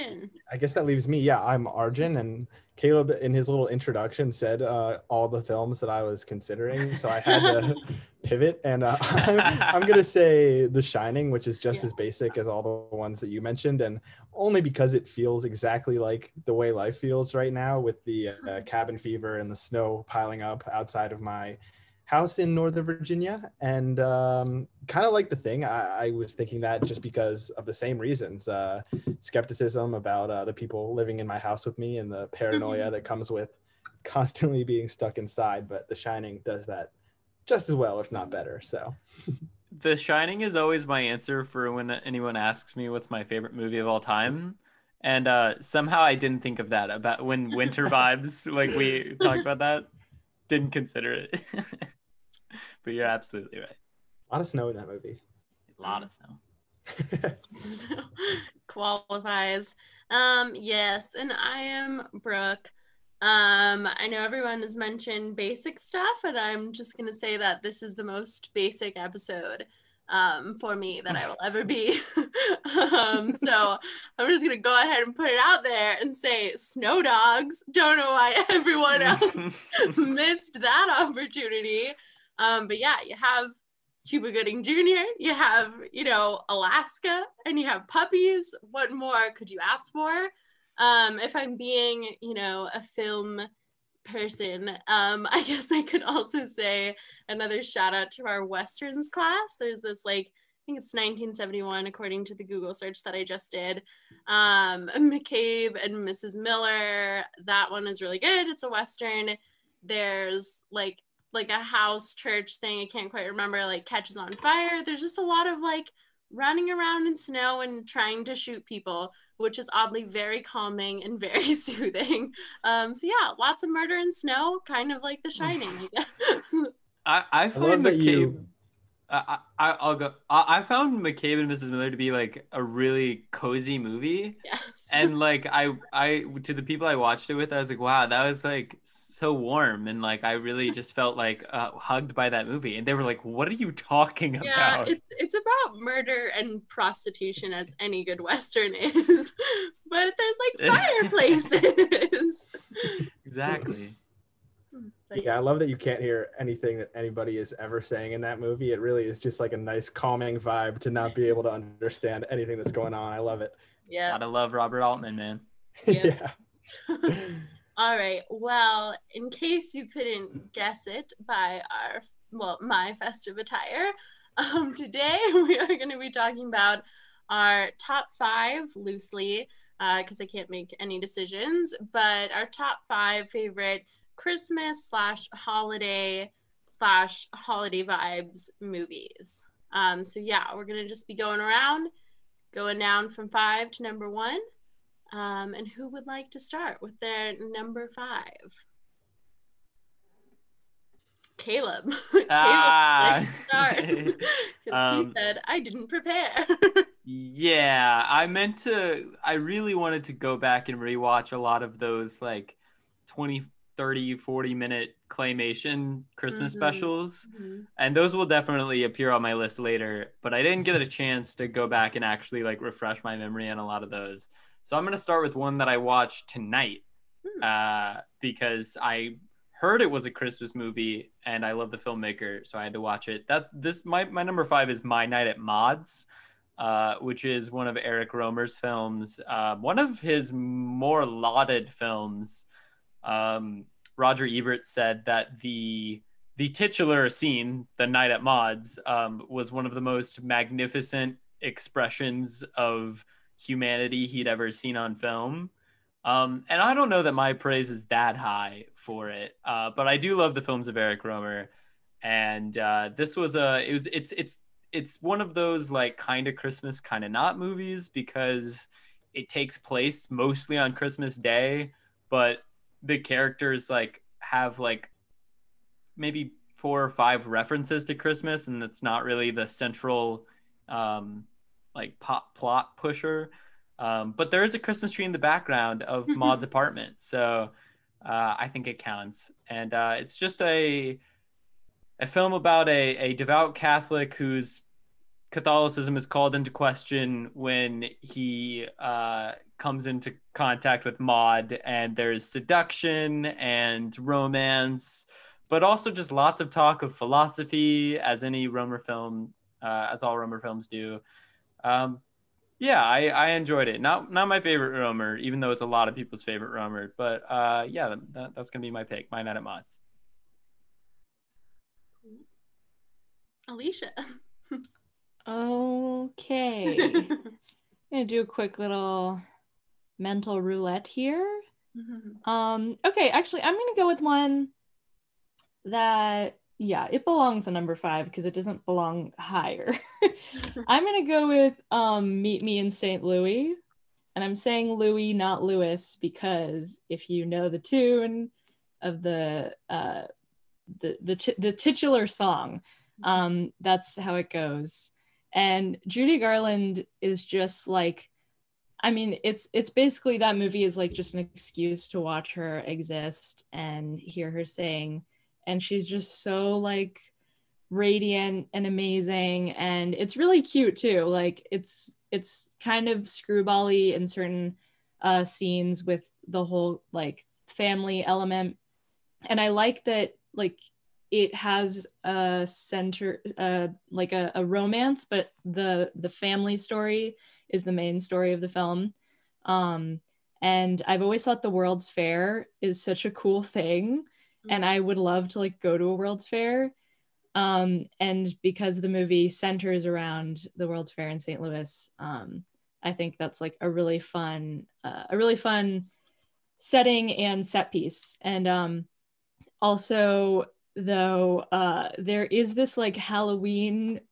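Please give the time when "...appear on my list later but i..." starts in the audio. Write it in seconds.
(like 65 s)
218 s.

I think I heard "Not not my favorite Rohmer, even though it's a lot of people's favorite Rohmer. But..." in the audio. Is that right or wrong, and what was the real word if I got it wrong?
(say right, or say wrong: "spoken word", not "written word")
right.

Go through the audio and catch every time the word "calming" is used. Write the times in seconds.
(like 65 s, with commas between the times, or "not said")
120 s, 159 s.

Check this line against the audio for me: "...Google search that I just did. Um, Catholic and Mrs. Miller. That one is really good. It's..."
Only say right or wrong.
wrong.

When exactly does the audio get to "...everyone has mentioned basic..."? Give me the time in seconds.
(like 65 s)
64 s.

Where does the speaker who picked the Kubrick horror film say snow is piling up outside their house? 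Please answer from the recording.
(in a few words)
Northern Virginia.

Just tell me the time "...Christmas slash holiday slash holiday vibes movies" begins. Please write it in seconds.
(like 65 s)
184 s.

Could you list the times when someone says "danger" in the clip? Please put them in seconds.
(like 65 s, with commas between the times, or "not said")
not said.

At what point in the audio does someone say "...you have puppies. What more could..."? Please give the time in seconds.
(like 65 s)
87 s.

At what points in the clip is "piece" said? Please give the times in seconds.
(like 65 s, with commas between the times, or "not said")
407 s.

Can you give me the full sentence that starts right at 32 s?
that comes with constantly being stuck inside.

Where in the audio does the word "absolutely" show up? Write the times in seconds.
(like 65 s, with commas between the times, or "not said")
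53 s.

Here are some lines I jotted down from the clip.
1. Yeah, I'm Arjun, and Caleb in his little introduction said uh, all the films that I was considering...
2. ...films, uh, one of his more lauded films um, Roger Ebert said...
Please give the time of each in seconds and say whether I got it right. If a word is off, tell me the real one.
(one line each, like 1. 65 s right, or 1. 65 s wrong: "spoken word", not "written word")
1. 1 s right
2. 238 s right.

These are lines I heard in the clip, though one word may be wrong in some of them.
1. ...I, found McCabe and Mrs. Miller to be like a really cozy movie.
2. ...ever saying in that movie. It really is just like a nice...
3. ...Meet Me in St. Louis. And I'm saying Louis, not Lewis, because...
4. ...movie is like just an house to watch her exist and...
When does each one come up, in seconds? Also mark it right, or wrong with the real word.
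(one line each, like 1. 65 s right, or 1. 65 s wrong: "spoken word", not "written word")
1. 130 s right
2. 157 s right
3. 342 s right
4. 360 s wrong: "excuse", not "house".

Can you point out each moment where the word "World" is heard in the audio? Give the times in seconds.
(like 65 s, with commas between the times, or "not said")
391 s, 395 s, 400 s.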